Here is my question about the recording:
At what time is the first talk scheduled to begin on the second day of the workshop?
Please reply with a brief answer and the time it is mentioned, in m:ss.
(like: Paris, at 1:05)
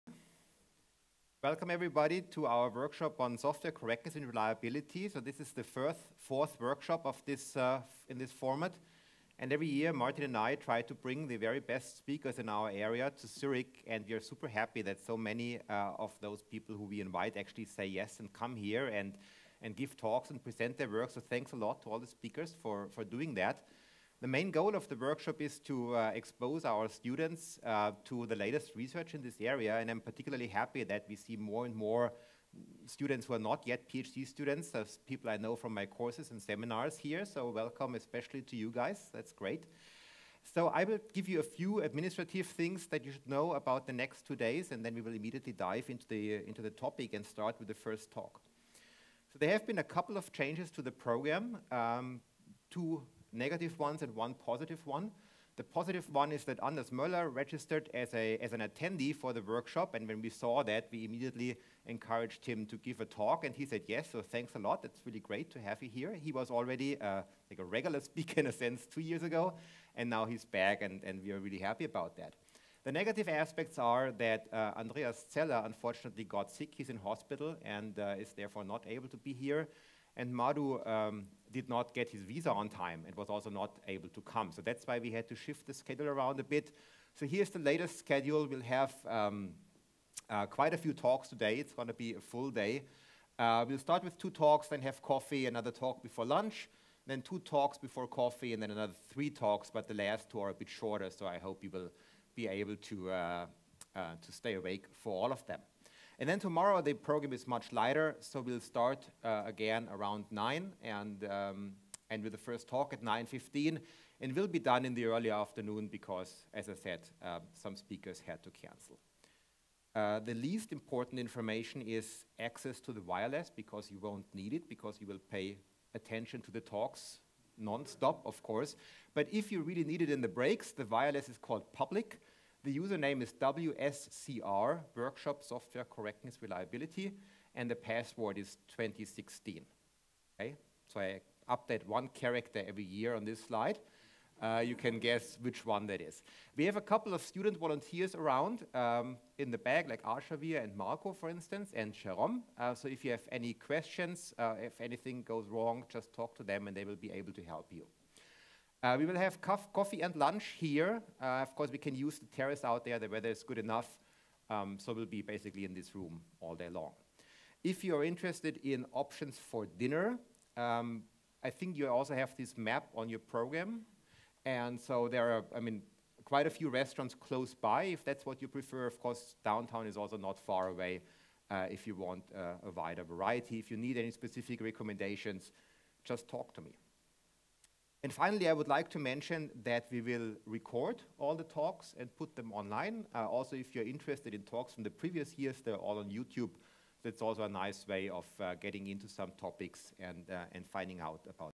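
9.15, at 1:53.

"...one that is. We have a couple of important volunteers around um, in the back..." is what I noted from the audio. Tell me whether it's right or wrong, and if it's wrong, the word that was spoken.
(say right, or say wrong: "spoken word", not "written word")
wrong: "student", not "important".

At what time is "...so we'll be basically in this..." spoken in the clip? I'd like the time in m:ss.
2:44.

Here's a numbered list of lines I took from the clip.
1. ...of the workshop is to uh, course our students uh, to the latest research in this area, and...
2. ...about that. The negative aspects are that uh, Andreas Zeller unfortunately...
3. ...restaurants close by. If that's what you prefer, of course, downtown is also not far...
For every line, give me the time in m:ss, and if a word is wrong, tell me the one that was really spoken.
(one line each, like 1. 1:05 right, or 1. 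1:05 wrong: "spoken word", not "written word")
1. 0:24 wrong: "expose", not "course"
2. 1:11 right
3. 2:56 right.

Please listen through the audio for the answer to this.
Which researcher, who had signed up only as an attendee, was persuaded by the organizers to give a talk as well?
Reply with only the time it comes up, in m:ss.
0:56.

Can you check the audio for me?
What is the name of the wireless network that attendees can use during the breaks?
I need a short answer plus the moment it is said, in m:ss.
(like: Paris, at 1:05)
public, at 2:11.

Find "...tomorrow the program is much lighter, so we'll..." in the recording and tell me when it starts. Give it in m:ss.
1:46.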